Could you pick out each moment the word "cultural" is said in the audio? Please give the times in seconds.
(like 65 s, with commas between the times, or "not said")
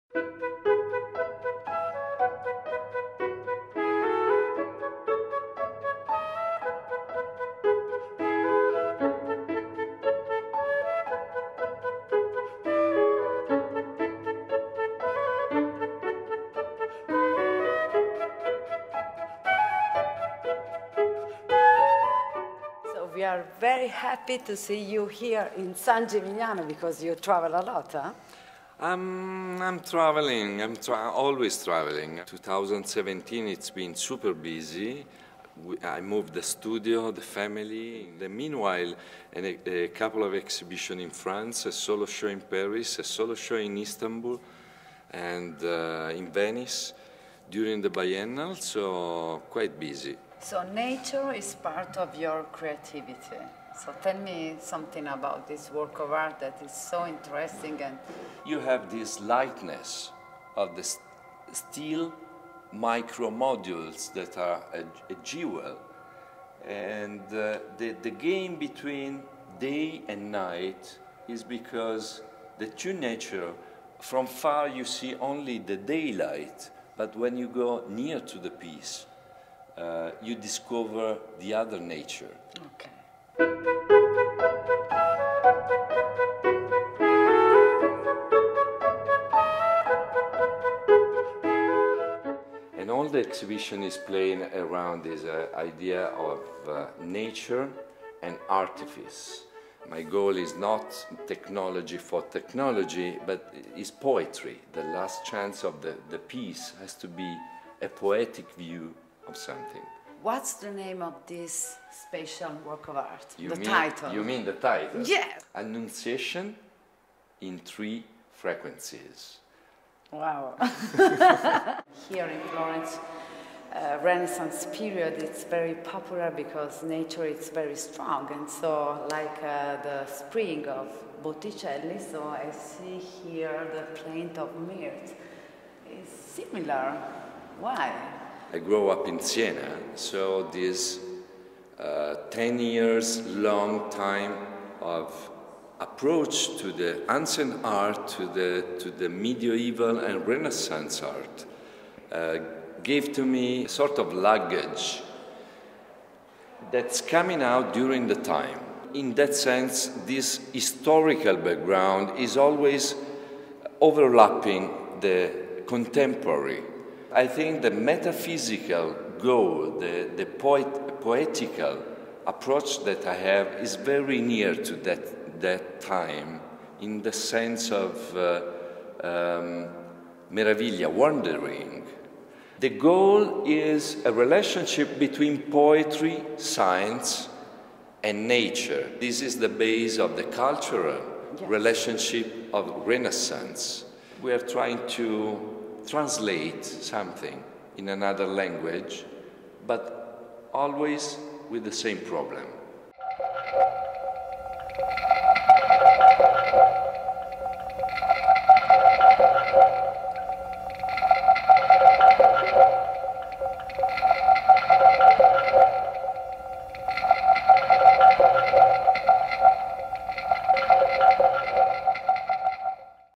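190 s.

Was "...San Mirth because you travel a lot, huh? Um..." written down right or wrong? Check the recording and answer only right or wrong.
wrong.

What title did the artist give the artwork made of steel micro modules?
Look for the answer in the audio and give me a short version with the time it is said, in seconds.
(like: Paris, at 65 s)
Annunciation in three frequencies, at 115 s.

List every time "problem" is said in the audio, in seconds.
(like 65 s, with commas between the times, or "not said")
201 s.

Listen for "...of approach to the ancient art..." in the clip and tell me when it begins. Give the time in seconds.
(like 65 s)
144 s.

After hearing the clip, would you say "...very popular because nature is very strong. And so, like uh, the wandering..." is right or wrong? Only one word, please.
wrong.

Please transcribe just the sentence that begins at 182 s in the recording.
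The goal is a relationship between poetry, science, and nature.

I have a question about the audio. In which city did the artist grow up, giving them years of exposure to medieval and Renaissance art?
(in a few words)
Siena.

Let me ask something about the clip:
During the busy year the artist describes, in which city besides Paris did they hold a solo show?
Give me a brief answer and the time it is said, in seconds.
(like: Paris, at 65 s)
Istanbul, at 43 s.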